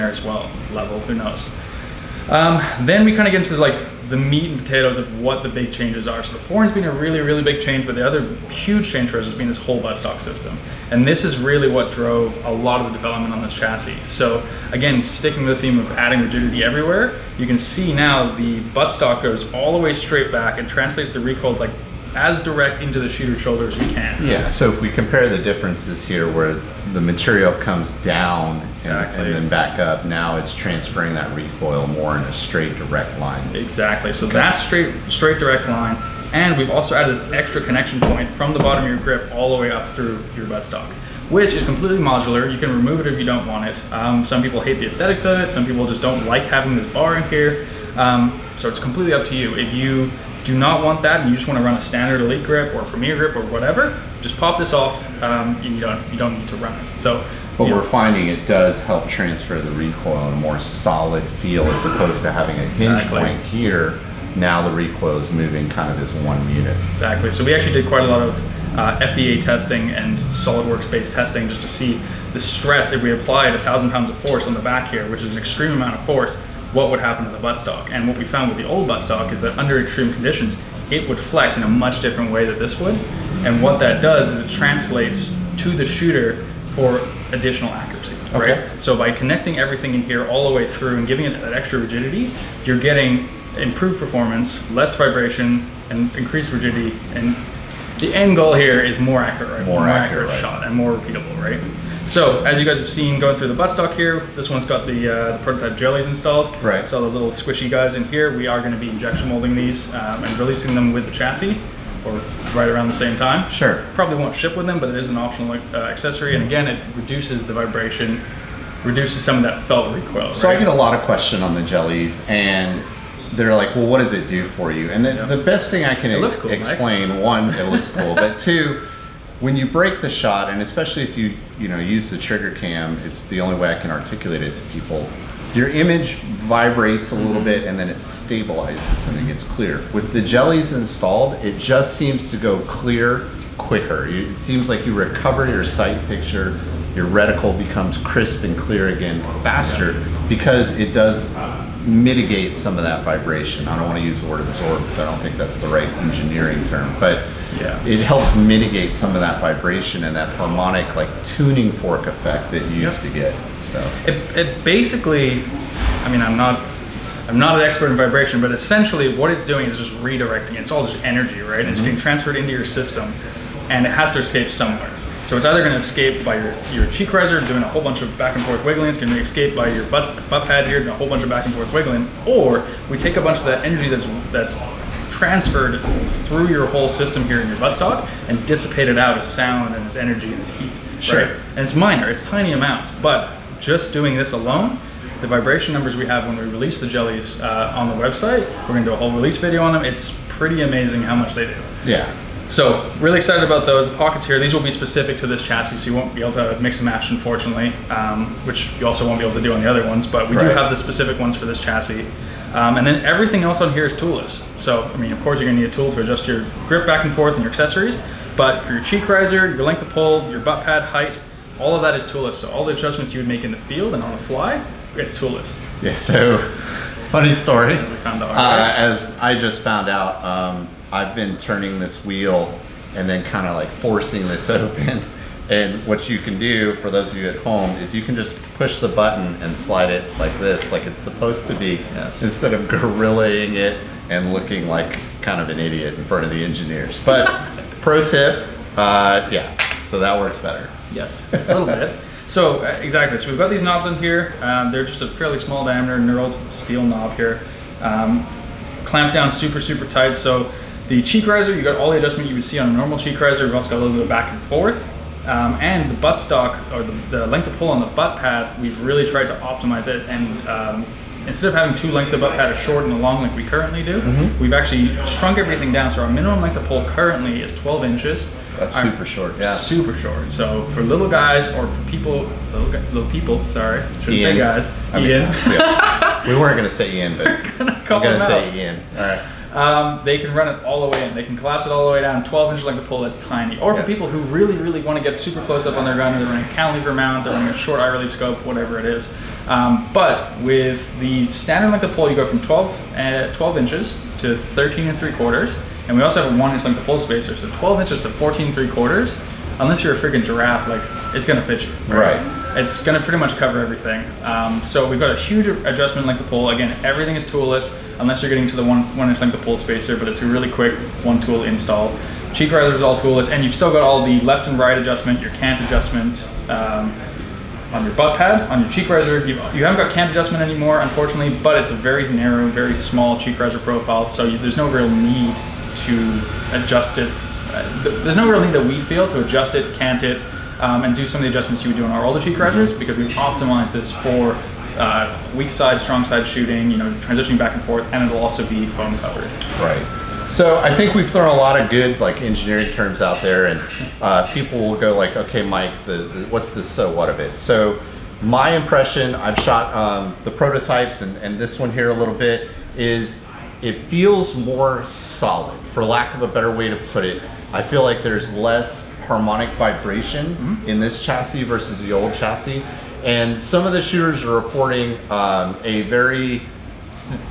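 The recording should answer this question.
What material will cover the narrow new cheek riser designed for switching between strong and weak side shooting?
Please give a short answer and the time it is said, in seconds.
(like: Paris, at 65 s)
foam, at 348 s.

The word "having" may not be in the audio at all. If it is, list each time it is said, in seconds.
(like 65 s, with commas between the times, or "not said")
46 s, 62 s, 271 s.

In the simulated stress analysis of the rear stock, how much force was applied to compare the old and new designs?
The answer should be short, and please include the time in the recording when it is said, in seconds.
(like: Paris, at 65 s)
1,000 pounds, at 73 s.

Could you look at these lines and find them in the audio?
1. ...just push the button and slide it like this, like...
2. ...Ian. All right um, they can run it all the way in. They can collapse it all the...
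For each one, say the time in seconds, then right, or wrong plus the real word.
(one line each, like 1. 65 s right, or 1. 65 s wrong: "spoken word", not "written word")
1. 238 s right
2. 288 s right.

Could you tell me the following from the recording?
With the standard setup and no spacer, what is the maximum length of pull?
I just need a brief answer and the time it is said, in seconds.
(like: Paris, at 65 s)
13 3/4 inches, at 304 s.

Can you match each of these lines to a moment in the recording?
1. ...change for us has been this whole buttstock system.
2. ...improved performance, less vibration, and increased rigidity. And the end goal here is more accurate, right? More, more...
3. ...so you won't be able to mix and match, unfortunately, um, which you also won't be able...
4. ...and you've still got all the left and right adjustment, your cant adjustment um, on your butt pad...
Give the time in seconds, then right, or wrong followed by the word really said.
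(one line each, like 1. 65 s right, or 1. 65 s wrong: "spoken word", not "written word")
1. 8 s right
2. 93 s right
3. 205 s right
4. 323 s right.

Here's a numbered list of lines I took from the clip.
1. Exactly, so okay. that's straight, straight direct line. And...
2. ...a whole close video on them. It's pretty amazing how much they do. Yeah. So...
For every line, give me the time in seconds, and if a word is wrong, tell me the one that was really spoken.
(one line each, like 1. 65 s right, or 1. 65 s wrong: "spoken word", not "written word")
1. 33 s right
2. 198 s wrong: "release", not "close".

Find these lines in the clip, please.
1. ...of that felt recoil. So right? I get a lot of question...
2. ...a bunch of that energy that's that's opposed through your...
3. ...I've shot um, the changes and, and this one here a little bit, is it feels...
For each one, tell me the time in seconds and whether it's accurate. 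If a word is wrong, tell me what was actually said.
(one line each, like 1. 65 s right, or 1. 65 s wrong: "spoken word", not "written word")
1. 119 s right
2. 183 s wrong: "transferred", not "opposed"
3. 359 s wrong: "prototypes", not "changes".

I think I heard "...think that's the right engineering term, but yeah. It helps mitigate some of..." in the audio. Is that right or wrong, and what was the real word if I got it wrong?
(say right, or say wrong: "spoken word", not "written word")
right.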